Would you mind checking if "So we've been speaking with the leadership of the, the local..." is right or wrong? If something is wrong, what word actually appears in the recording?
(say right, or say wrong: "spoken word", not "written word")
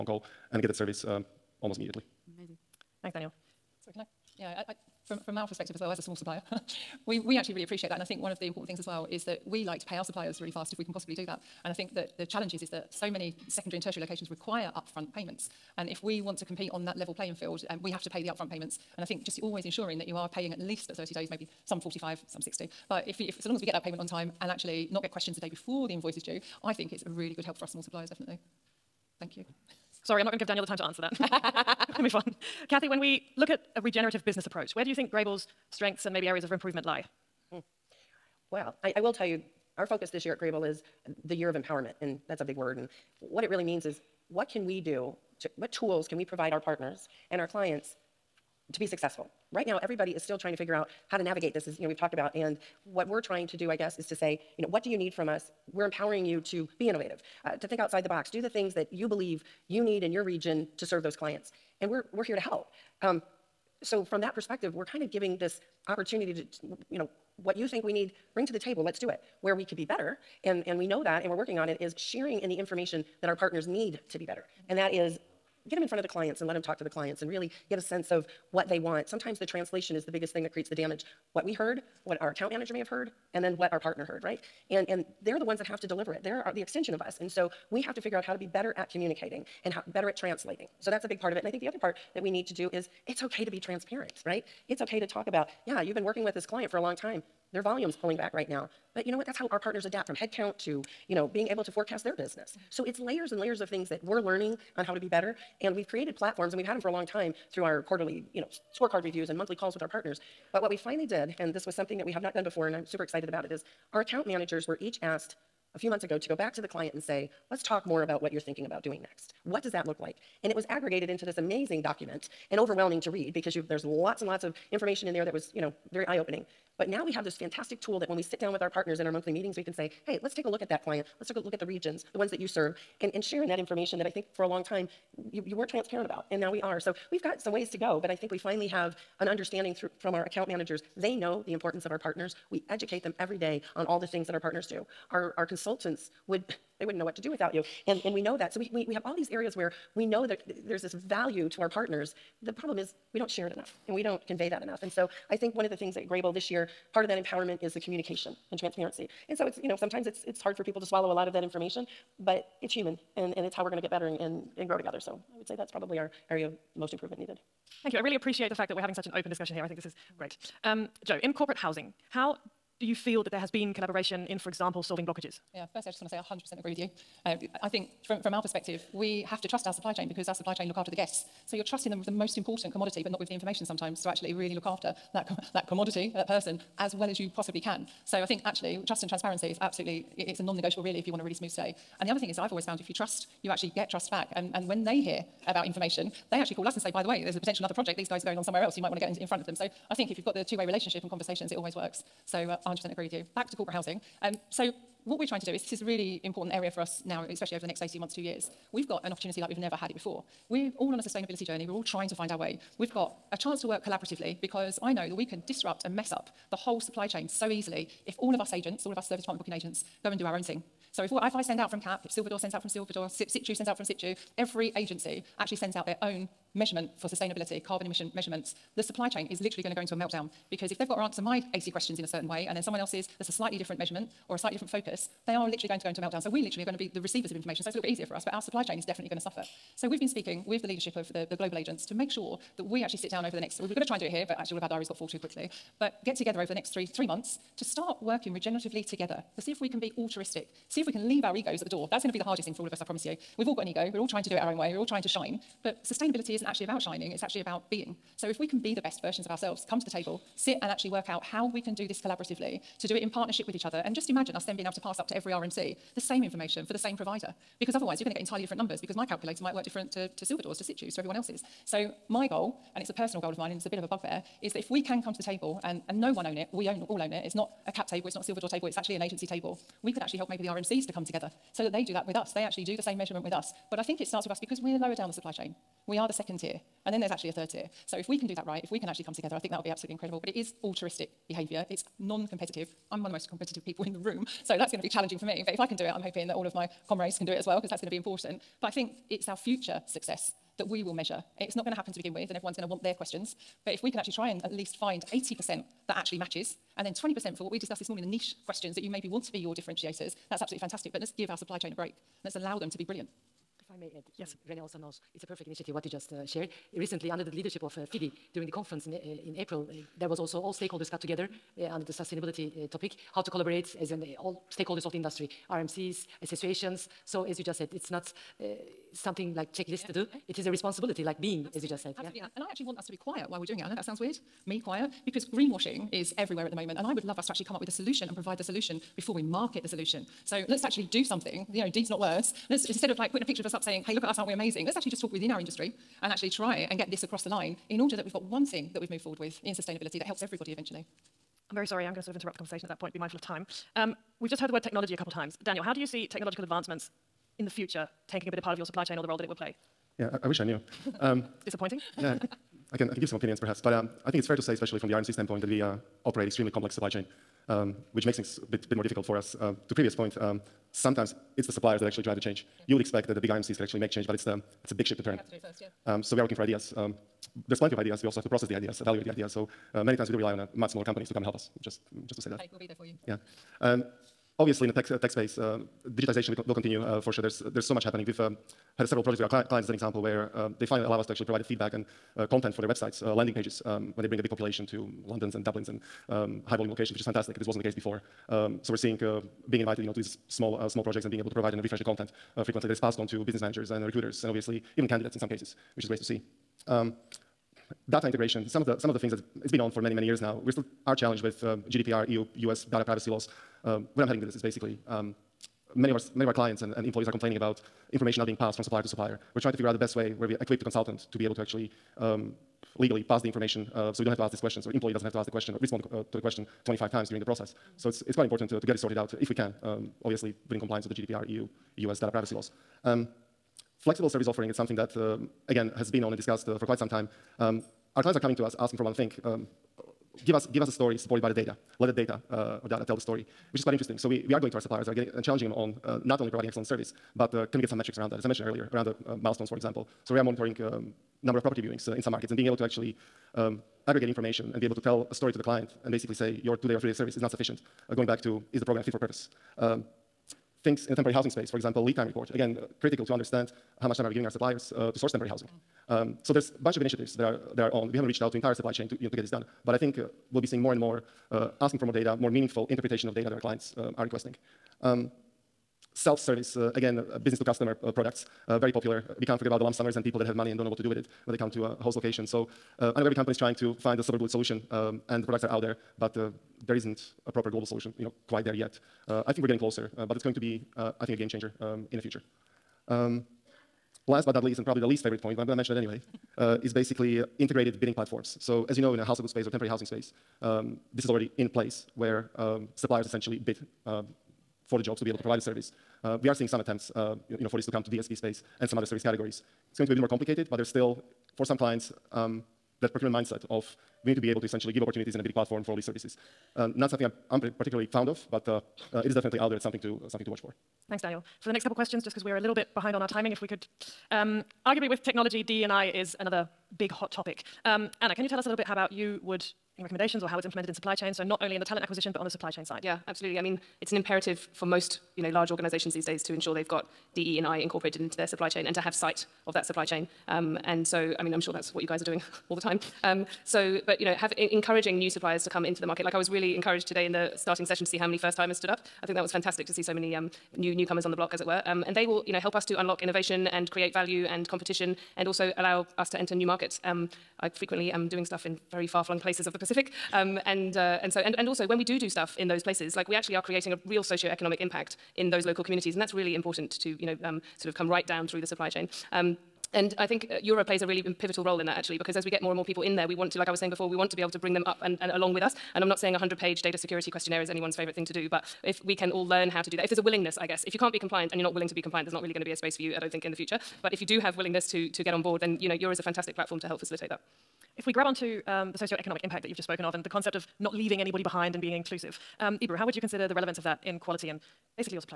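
wrong: "global", not "local".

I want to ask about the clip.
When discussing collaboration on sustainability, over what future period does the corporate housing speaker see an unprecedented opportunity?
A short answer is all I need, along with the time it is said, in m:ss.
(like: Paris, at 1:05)
18 months, two years, at 3:27.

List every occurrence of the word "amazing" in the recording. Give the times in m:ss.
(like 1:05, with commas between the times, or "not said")
0:02, 2:01, 5:44.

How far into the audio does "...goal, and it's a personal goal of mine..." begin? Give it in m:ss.
4:32.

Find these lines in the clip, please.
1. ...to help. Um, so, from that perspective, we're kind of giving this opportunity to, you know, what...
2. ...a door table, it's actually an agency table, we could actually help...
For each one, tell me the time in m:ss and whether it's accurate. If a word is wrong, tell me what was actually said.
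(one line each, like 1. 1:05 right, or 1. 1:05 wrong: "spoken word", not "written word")
1. 1:02 right
2. 4:38 right.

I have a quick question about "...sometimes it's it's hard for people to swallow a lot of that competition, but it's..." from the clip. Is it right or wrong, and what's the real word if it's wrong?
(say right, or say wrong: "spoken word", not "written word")
wrong: "information", not "competition".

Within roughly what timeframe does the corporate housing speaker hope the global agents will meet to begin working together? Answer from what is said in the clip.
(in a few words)
three months.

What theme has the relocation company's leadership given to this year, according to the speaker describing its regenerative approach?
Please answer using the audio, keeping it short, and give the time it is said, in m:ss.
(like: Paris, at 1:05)
year of empowerment, at 0:41.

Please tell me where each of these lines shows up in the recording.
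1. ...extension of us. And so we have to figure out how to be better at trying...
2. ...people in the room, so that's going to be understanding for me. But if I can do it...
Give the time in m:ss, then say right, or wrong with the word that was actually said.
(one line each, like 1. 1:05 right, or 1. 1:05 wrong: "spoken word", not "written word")
1. 1:26 wrong: "communicating", not "trying"
2. 4:53 wrong: "challenging", not "understanding".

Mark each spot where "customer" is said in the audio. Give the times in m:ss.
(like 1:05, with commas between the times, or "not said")
7:57.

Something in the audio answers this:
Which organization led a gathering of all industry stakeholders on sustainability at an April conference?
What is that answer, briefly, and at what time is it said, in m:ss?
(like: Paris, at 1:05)
FIDI, at 5:17.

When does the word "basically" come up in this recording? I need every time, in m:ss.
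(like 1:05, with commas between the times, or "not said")
6:54, 7:35, 8:16.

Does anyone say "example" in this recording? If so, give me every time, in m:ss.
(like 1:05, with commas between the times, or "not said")
2:54, 6:29, 7:29, 7:41.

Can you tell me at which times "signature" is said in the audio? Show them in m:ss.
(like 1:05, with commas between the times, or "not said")
not said.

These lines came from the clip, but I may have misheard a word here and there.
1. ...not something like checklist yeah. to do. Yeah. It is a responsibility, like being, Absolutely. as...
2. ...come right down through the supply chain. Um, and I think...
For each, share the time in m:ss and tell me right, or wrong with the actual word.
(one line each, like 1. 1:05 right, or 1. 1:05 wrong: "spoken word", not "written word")
1. 5:27 right
2. 9:27 right.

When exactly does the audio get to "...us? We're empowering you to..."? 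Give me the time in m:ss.
0:55.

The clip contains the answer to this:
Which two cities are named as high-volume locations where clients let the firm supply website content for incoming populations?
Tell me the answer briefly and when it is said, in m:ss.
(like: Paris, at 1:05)
London and Dublin, at 6:35.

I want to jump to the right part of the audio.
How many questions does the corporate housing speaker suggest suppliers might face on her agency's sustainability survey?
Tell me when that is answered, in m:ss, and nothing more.
3:51.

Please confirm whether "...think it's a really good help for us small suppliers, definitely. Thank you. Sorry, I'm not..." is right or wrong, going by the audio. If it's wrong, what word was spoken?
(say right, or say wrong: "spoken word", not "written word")
right.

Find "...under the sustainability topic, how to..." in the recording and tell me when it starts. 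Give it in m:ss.
5:21.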